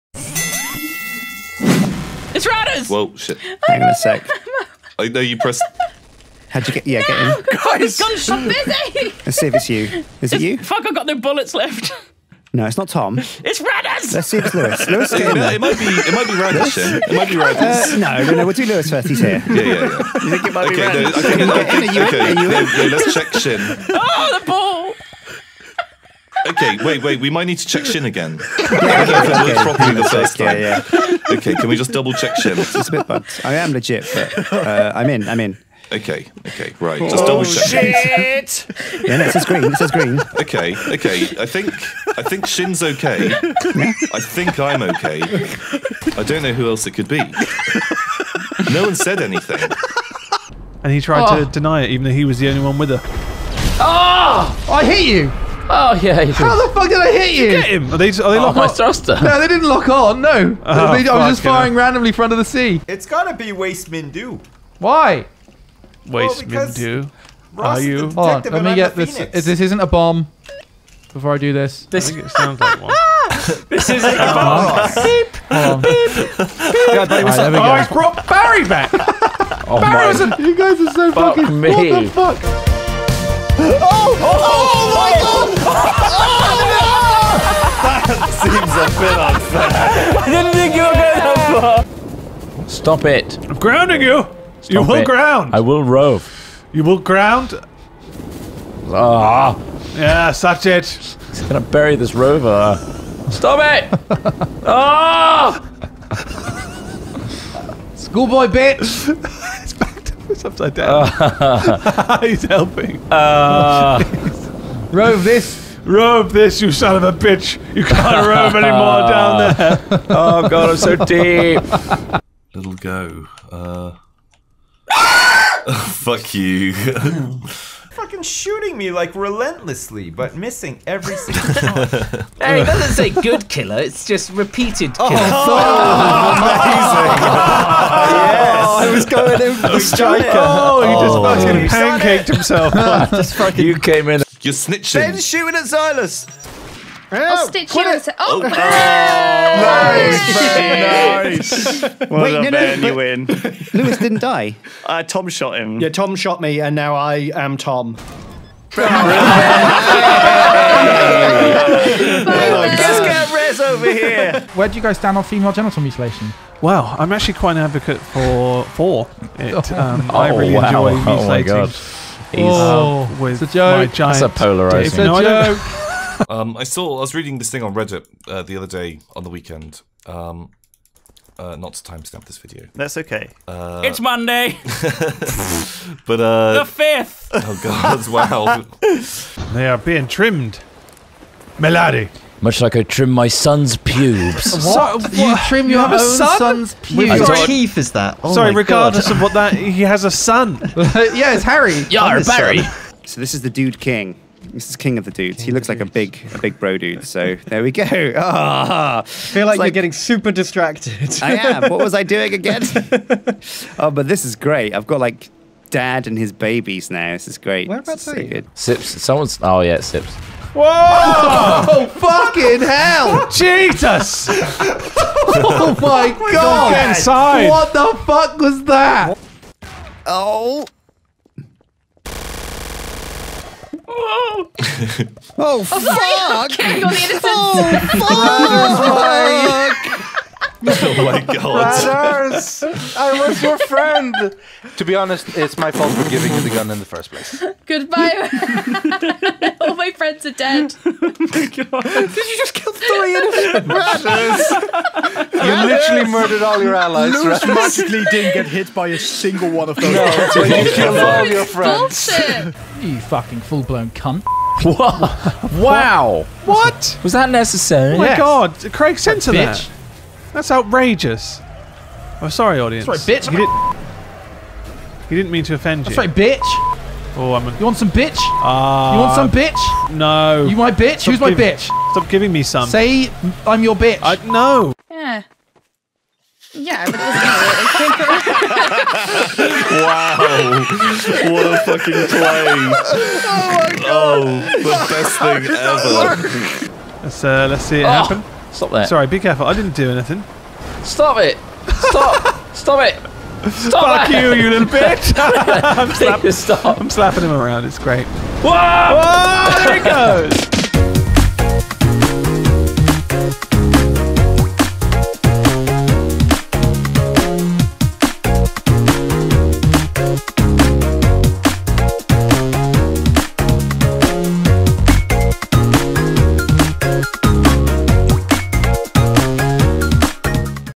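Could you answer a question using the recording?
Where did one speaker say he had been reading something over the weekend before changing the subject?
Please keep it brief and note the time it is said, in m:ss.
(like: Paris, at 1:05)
Reddit, at 2:57.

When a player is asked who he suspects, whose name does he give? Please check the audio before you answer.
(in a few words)
Waste Mindu.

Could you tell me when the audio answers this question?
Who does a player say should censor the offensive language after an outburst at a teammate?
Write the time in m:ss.
4:28.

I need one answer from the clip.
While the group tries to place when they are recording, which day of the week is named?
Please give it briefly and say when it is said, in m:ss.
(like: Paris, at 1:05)
Monday, at 3:03.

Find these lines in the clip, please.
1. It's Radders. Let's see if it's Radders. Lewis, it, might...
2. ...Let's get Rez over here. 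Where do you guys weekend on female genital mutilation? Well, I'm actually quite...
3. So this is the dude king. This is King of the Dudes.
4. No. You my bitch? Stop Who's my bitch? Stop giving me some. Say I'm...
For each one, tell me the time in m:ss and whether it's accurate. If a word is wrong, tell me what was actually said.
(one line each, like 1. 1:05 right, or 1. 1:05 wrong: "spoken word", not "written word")
1. 0:13 wrong: "Lewis", not "Radders"
2. 2:38 wrong: "stand", not "weekend"
3. 3:23 right
4. 4:39 right.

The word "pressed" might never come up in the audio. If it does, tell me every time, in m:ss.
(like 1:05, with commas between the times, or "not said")
0:05.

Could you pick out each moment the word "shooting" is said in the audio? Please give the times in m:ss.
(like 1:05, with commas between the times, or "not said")
2:08, 2:25.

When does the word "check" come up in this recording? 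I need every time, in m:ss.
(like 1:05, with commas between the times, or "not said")
0:23, 0:27, 0:32, 0:37.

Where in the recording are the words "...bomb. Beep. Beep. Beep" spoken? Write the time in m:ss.
1:14.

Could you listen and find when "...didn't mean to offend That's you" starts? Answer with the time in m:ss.
4:35.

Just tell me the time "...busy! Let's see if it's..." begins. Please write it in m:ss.
0:08.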